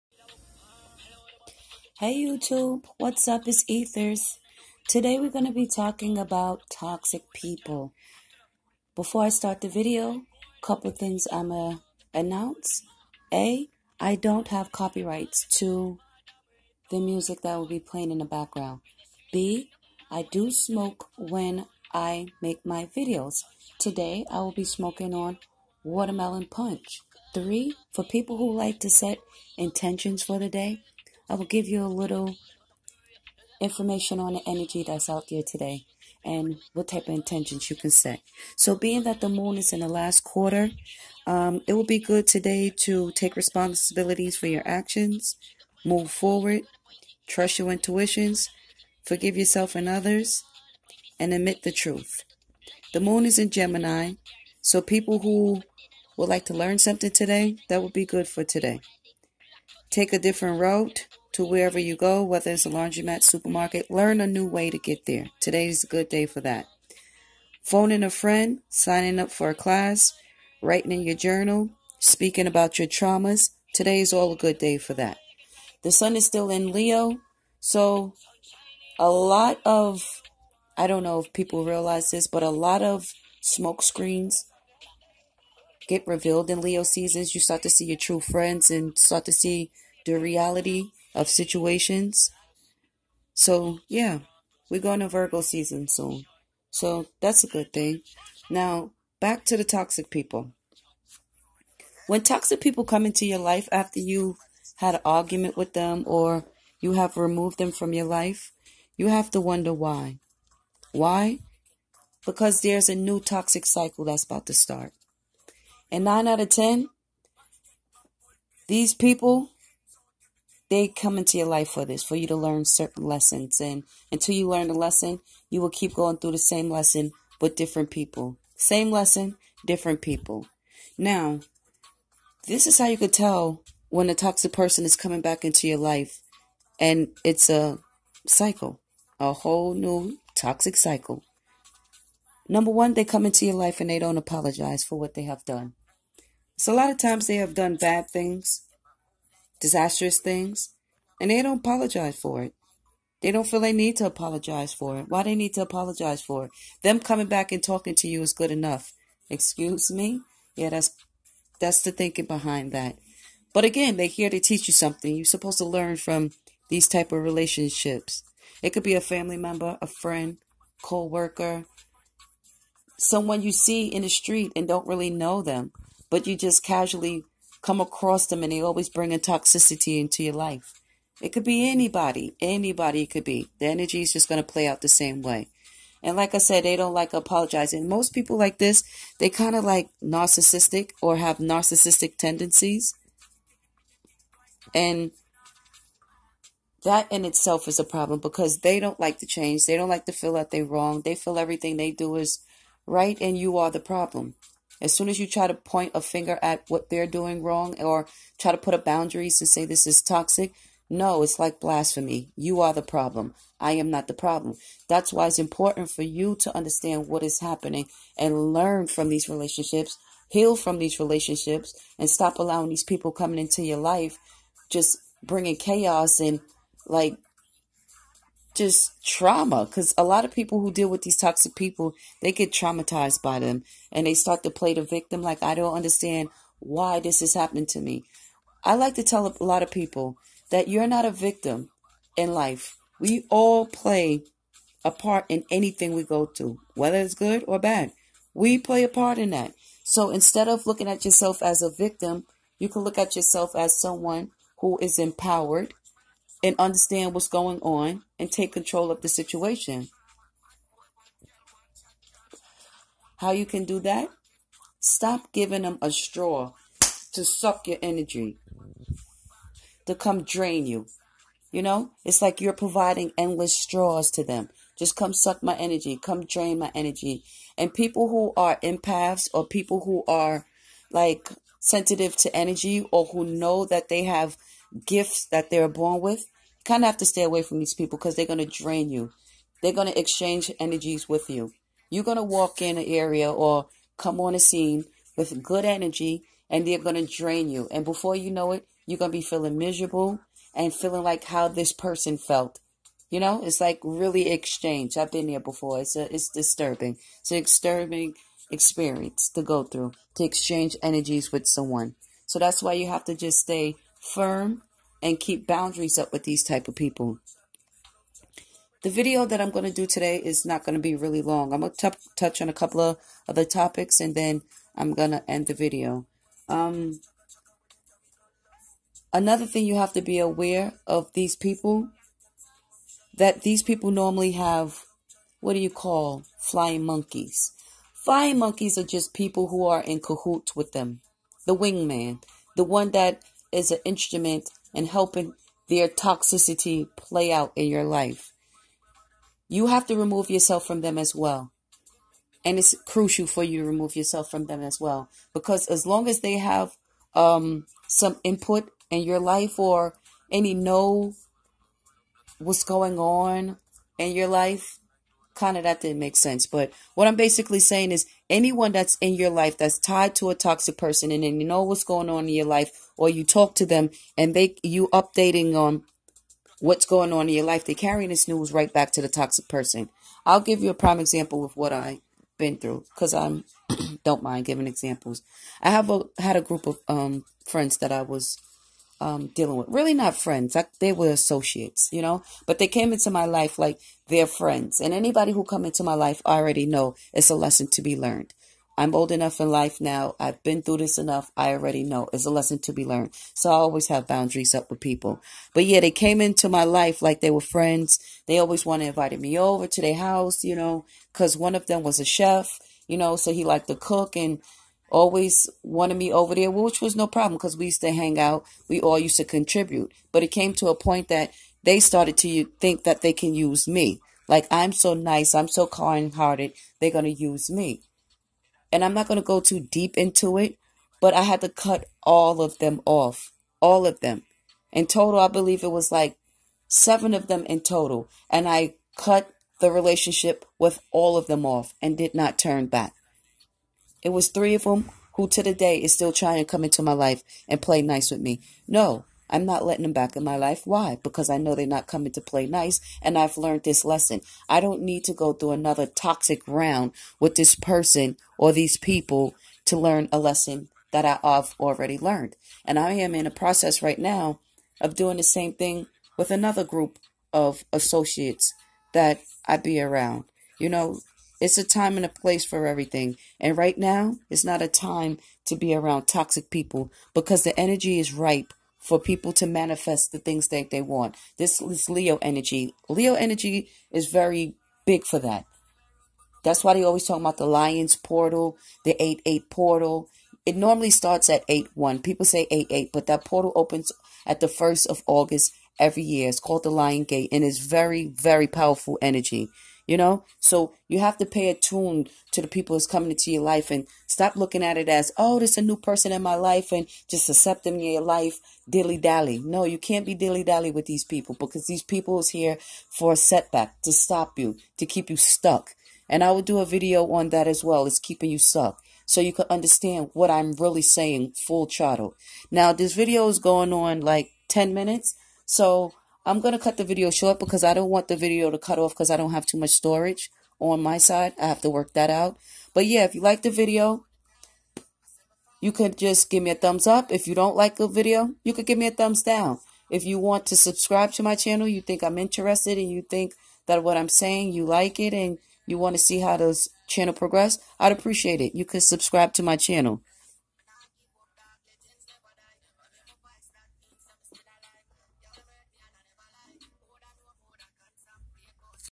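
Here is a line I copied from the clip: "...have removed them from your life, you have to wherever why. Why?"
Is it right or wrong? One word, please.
wrong.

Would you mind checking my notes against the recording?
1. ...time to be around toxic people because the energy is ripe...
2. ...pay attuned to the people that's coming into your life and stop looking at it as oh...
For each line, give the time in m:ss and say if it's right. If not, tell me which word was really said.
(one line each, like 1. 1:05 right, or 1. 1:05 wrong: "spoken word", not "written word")
1. 7:54 right
2. 8:21 right.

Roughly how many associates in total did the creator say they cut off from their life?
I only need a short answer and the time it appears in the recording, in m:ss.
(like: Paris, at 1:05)
7, at 7:16.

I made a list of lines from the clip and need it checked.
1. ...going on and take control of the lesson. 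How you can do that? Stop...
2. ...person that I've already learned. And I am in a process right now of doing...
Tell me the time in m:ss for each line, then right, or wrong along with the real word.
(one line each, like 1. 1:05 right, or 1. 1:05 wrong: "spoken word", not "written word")
1. 4:17 wrong: "situation", not "lesson"
2. 7:40 wrong: "lesson", not "person".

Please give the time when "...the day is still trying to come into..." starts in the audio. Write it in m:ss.
7:25.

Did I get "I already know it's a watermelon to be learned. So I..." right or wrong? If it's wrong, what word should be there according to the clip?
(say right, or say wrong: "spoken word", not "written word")
wrong: "lesson", not "watermelon".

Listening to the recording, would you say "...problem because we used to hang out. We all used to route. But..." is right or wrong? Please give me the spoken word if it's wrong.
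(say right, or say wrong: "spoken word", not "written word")
wrong: "contribute", not "route".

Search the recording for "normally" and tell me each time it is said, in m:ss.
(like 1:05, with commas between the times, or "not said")
5:33, 8:10.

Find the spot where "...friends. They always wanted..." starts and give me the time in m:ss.
6:47.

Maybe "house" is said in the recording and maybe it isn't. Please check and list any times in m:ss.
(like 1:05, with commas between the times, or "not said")
6:49.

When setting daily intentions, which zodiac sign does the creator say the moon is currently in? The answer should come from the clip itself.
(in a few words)
Gemini.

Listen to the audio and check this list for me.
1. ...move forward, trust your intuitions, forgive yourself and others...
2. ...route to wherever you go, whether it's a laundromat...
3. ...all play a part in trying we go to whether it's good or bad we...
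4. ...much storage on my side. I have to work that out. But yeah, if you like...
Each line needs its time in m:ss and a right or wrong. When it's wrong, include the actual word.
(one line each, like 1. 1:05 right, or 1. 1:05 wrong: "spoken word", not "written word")
1. 0:45 right
2. 1:00 right
3. 4:03 wrong: "anything", not "trying"
4. 8:49 right.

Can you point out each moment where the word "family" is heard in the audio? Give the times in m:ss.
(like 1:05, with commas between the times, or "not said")
2:49.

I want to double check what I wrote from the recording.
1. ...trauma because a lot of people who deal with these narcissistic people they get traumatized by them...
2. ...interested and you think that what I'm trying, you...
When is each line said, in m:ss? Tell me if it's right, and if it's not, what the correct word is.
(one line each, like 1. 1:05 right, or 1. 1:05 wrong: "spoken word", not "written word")
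1. 3:49 wrong: "toxic", not "narcissistic"
2. 9:02 wrong: "saying", not "trying".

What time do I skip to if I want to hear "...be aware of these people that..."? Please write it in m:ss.
5:30.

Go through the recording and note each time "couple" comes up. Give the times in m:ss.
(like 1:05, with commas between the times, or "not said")
0:10, 5:22.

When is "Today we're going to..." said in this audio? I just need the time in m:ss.
0:04.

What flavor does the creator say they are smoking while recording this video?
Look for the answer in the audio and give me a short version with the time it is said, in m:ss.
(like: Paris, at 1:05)
watermelon punch, at 0:25.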